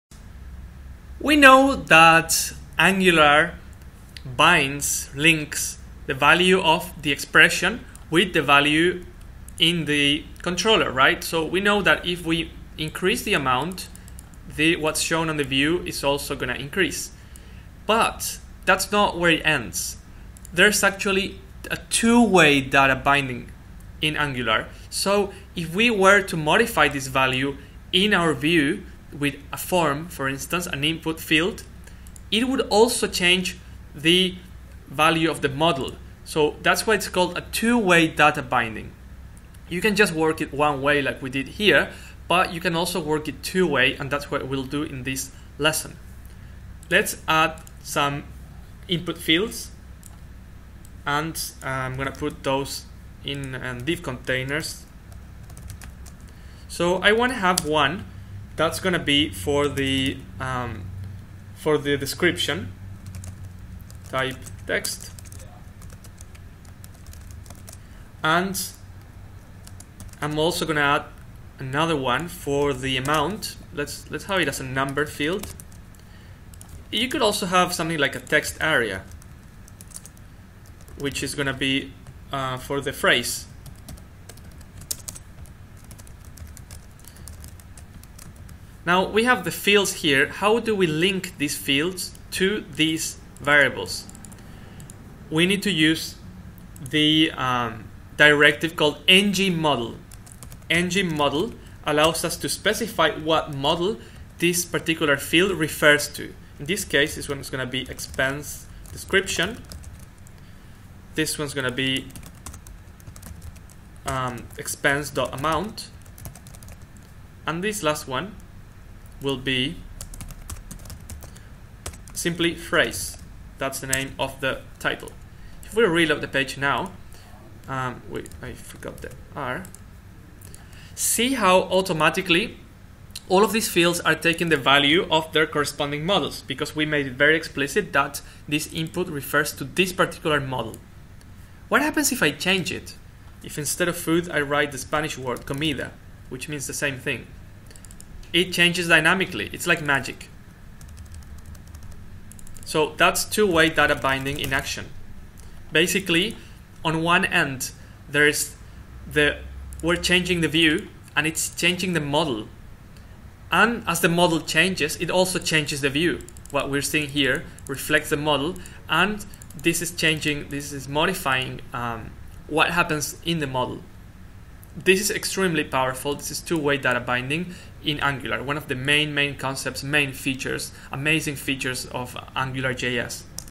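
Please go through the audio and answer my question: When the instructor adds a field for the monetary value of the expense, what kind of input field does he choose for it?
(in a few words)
number field.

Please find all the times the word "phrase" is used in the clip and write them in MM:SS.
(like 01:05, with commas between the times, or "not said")
01:22, 02:02.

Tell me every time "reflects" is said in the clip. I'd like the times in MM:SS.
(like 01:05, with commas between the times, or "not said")
02:47.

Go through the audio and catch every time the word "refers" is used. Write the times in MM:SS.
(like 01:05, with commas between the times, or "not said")
01:45, 02:19.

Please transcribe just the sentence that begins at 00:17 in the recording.
But that's not where it ends.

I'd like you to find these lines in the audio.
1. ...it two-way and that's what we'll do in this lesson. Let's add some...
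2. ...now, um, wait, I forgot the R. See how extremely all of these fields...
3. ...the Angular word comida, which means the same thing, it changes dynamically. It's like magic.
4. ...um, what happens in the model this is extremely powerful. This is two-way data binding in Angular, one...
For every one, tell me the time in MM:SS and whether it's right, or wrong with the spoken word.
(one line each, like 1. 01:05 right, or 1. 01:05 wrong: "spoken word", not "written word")
1. 00:43 right
2. 02:06 wrong: "automatically", not "extremely"
3. 02:24 wrong: "Spanish", not "Angular"
4. 02:51 right.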